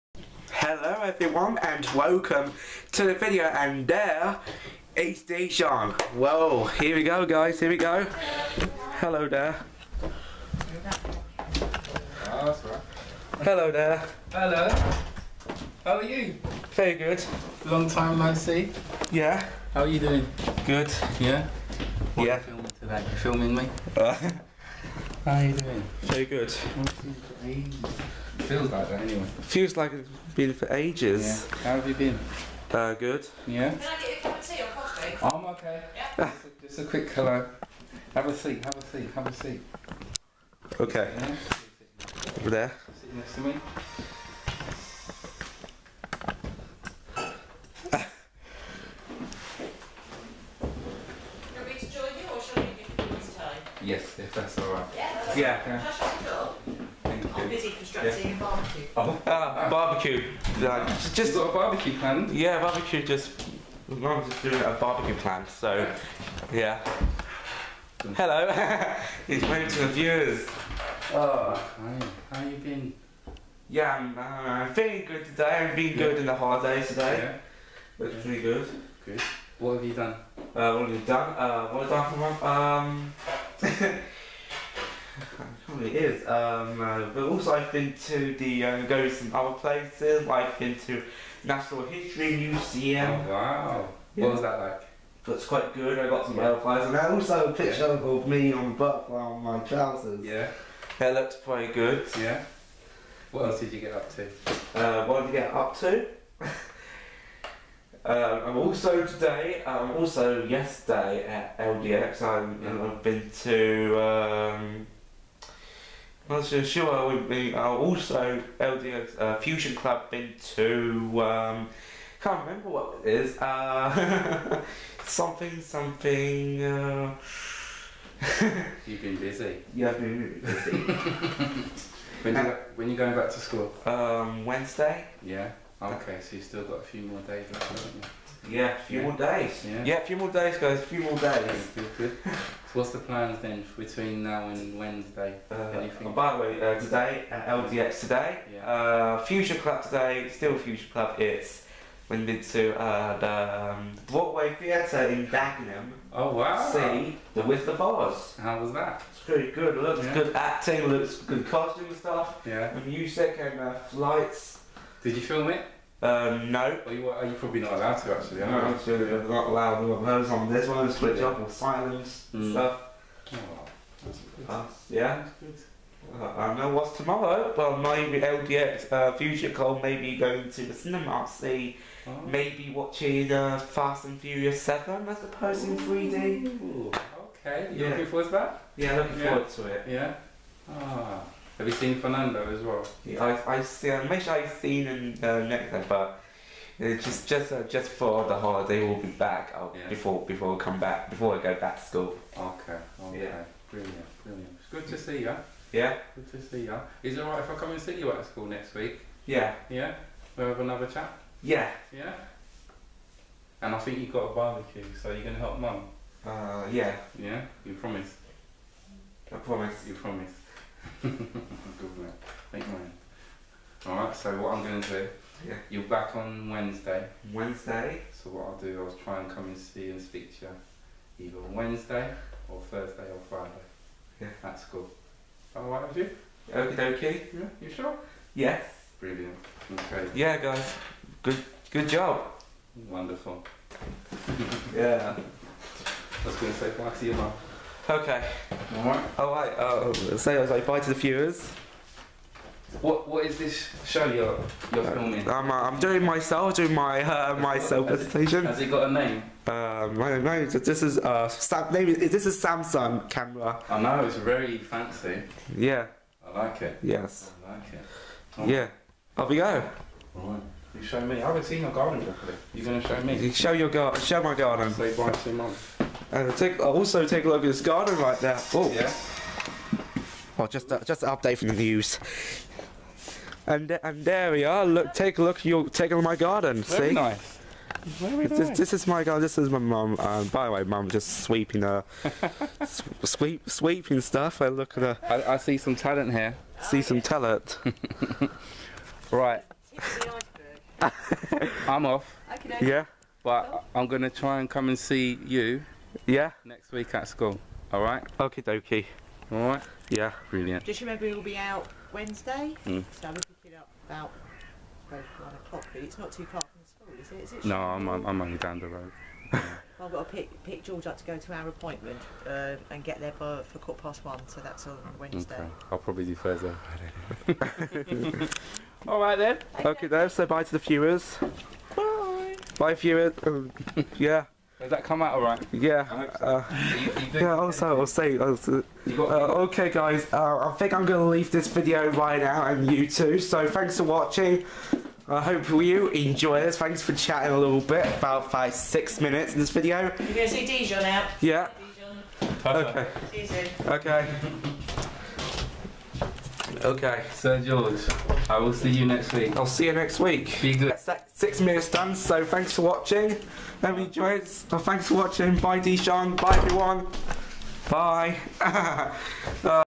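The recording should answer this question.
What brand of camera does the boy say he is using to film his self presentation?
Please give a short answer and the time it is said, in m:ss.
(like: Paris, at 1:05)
Samsung, at 4:22.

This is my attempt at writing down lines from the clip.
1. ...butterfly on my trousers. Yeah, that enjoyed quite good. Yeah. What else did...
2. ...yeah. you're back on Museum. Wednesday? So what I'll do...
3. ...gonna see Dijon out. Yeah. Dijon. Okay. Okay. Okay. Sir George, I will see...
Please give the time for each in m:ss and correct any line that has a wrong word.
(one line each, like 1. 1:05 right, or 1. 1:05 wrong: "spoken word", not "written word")
1. 1:38 wrong: "looked", not "enjoyed"
2. 3:45 wrong: "Wednesday", not "Museum"
3. 5:50 right.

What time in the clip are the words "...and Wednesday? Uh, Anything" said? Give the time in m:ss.
2:24.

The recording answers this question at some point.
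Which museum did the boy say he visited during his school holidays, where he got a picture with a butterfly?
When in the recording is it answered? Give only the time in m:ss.
1:31.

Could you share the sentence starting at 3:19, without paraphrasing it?
before before I come back before I go back to school.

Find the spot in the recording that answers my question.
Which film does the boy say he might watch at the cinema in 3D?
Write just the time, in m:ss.
3:03.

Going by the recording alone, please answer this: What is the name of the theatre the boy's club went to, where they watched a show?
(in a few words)
Broadway Theatre.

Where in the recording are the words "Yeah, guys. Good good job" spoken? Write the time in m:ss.
4:00.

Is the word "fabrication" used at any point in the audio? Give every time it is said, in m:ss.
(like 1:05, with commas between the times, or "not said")
not said.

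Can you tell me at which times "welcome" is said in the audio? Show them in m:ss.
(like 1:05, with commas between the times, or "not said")
0:01.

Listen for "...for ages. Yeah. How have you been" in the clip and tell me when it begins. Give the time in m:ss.
0:30.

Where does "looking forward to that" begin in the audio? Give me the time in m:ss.
3:07.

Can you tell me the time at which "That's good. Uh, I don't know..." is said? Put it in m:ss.
2:55.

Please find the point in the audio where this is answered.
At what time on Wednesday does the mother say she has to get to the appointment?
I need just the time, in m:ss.
5:23.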